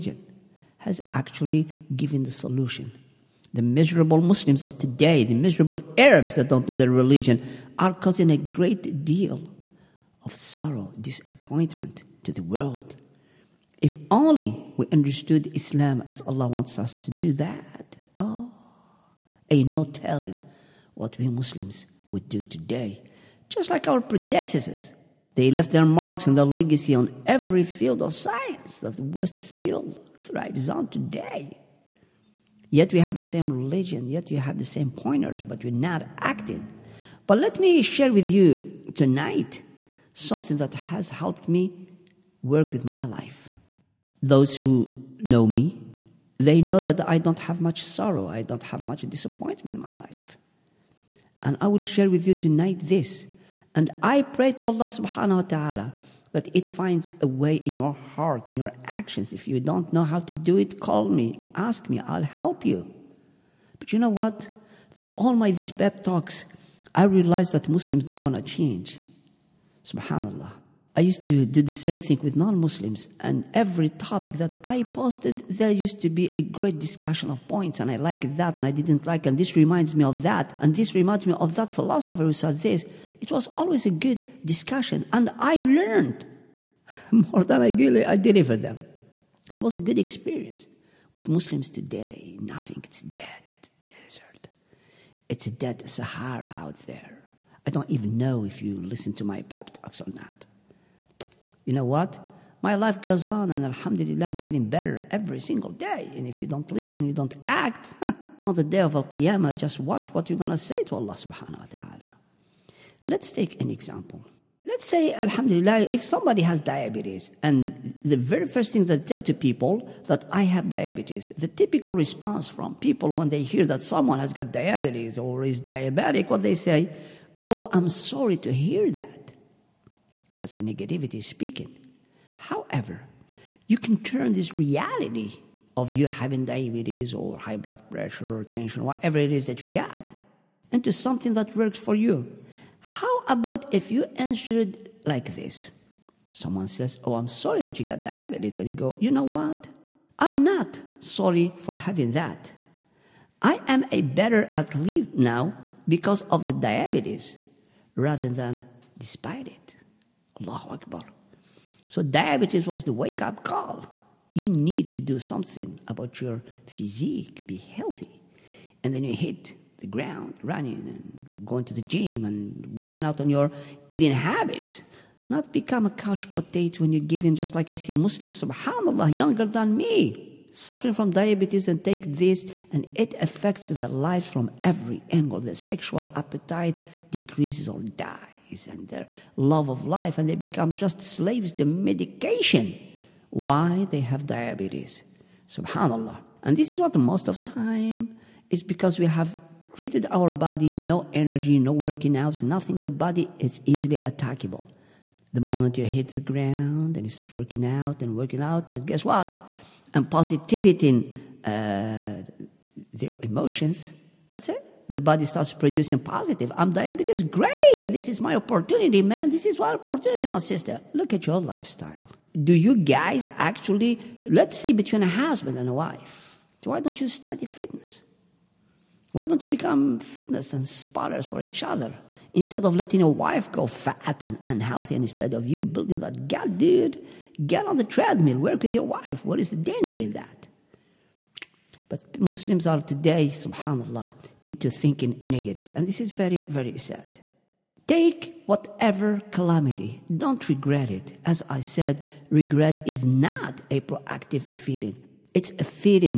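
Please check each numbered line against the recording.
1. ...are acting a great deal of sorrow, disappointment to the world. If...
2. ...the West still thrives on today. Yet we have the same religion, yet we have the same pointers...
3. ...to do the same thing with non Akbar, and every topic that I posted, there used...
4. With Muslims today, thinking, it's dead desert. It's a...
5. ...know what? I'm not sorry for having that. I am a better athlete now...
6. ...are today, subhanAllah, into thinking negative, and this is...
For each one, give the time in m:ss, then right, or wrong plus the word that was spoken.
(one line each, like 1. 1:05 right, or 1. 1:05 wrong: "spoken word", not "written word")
1. 0:07 wrong: "causing", not "acting"
2. 0:28 right
3. 1:11 wrong: "Muslims", not "Akbar"
4. 1:31 wrong: "nothing", not "thinking"
5. 2:29 right
6. 4:02 right.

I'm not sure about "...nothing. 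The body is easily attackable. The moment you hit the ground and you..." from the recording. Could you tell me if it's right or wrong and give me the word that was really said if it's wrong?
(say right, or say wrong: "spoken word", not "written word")
right.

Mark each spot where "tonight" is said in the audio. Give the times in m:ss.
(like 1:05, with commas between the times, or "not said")
0:38, 0:52.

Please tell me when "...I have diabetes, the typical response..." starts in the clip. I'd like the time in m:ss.
2:00.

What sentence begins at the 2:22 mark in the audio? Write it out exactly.
How about if you answered like this?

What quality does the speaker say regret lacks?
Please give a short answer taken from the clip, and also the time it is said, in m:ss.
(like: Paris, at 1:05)
proactive, at 4:13.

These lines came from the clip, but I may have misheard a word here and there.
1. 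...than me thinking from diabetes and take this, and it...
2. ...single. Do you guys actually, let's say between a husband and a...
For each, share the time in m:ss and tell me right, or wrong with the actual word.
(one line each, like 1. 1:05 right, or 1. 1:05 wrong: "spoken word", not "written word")
1. 2:59 wrong: "suffering", not "thinking"
2. 3:41 wrong: "lifestyle", not "single".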